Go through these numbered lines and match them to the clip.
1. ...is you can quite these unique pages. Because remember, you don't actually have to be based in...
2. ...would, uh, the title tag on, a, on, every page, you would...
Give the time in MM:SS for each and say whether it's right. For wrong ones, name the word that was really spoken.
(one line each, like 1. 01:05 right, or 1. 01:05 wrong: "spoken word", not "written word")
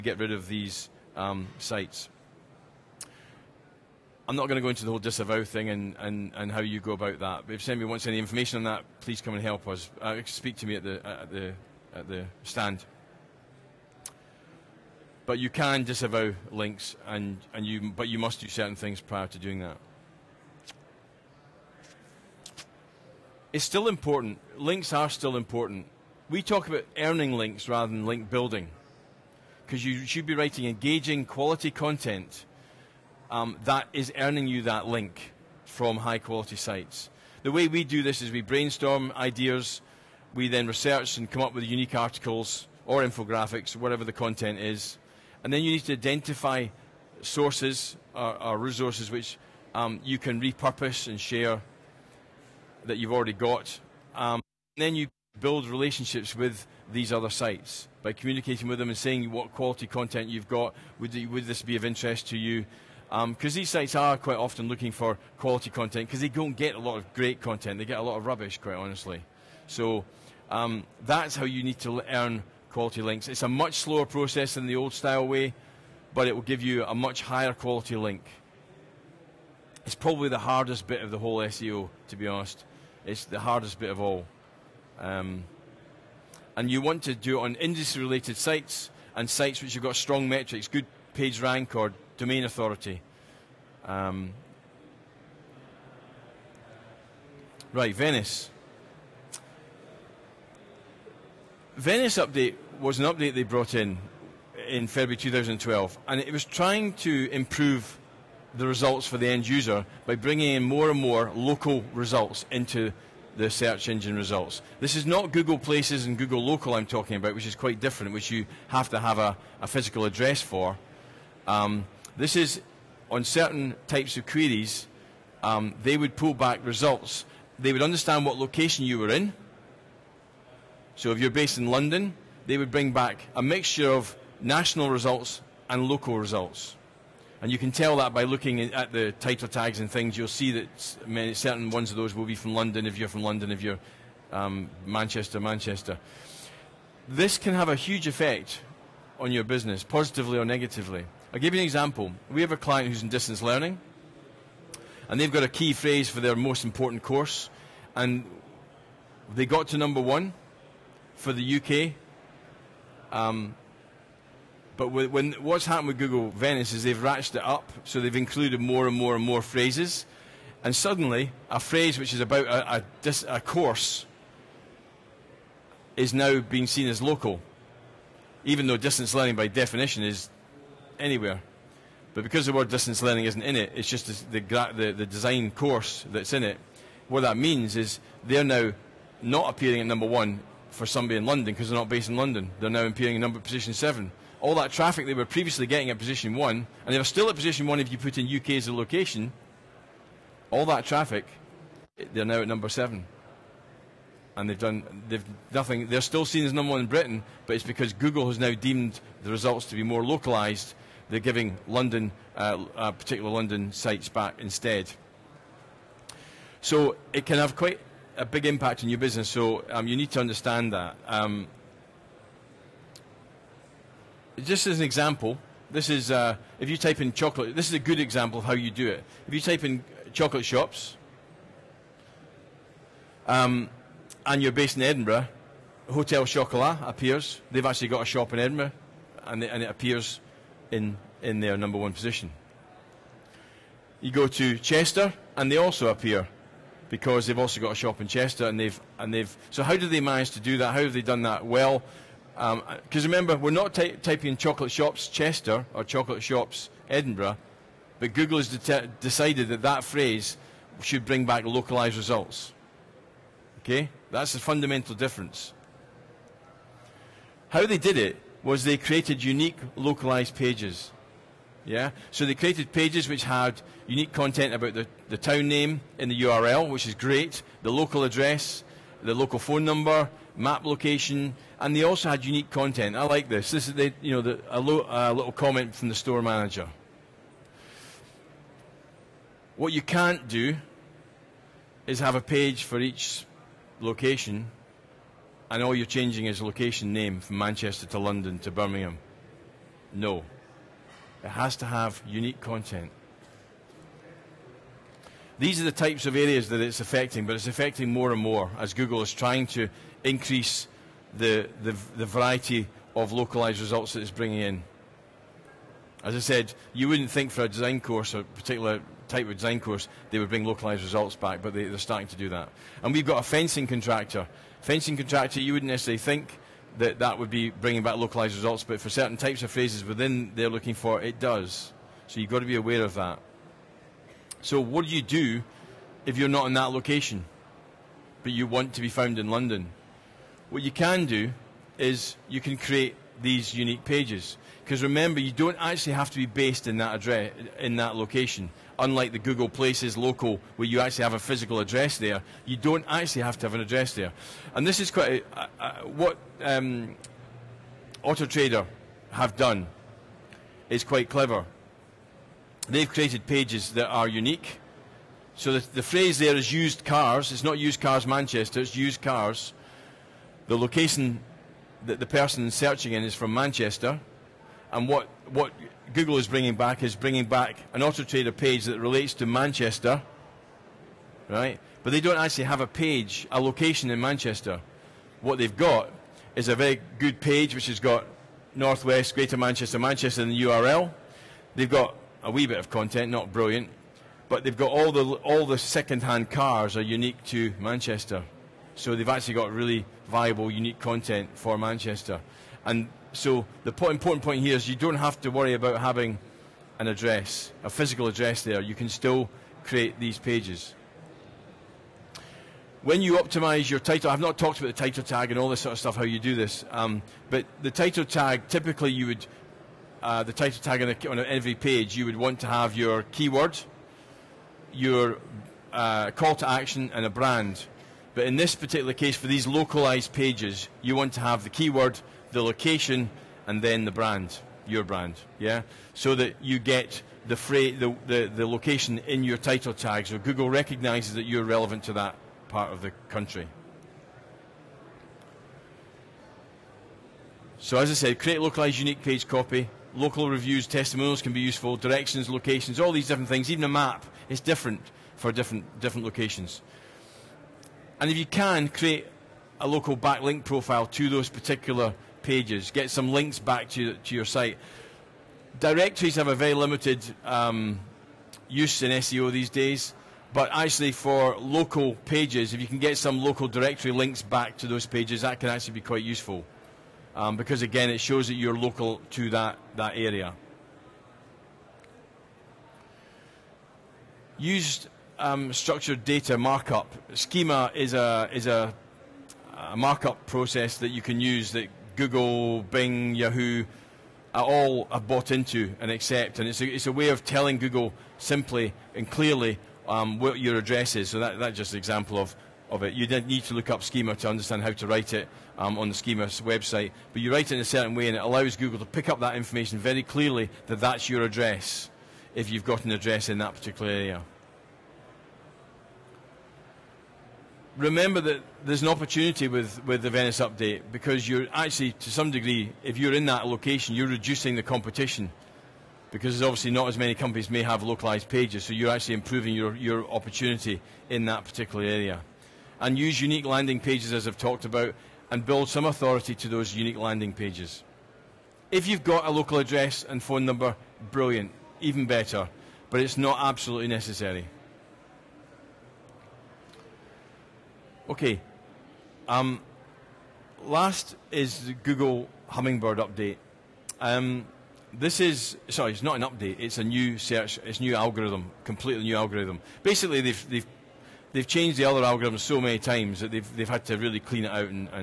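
1. 05:41 wrong: "create", not "quite"
2. 06:59 right.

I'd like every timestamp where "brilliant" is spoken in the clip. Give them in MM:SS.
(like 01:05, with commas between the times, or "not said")
06:33, 09:01.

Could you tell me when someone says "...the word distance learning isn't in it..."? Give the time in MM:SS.
03:02.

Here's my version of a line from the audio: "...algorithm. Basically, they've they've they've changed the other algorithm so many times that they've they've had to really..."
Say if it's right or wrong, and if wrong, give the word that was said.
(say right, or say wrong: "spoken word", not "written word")
right.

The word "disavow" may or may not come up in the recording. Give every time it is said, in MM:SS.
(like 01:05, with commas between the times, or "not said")
00:04, 00:15.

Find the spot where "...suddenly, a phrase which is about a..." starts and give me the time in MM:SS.
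02:50.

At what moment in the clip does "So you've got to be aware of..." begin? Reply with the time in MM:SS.
05:32.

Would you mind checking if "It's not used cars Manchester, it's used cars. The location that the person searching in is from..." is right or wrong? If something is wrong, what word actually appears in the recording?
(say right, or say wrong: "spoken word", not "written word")
right.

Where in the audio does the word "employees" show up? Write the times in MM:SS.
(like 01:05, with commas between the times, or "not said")
not said.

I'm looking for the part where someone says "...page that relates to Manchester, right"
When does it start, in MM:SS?
06:18.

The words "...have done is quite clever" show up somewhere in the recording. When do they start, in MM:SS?
05:59.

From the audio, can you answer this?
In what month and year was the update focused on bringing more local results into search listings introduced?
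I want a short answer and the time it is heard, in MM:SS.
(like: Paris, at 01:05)
February 2012, at 01:44.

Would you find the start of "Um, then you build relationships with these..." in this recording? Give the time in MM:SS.
00:54.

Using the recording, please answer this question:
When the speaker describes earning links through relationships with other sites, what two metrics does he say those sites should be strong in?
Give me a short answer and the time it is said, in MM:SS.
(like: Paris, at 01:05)
page rank or domain authority, at 01:30.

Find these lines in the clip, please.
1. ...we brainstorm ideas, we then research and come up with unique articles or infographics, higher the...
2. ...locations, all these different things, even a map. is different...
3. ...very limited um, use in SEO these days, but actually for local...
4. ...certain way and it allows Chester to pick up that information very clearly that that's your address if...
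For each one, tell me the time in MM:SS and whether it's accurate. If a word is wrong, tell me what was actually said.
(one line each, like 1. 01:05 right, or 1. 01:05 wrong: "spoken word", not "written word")
1. 00:38 wrong: "whatever", not "higher"
2. 07:32 right
3. 07:46 right
4. 08:27 wrong: "Google", not "Chester".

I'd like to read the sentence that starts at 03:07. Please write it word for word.
What that means is they're now not appearing at number one for somebody in London because they're not based in London.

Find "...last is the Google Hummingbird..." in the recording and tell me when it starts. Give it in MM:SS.
09:10.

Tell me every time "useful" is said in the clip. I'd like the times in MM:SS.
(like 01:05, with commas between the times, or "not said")
07:31, 07:56.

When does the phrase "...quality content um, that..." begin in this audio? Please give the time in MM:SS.
00:31.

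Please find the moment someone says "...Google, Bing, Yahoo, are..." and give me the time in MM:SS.
08:11.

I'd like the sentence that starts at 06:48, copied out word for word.
You can still create these pages.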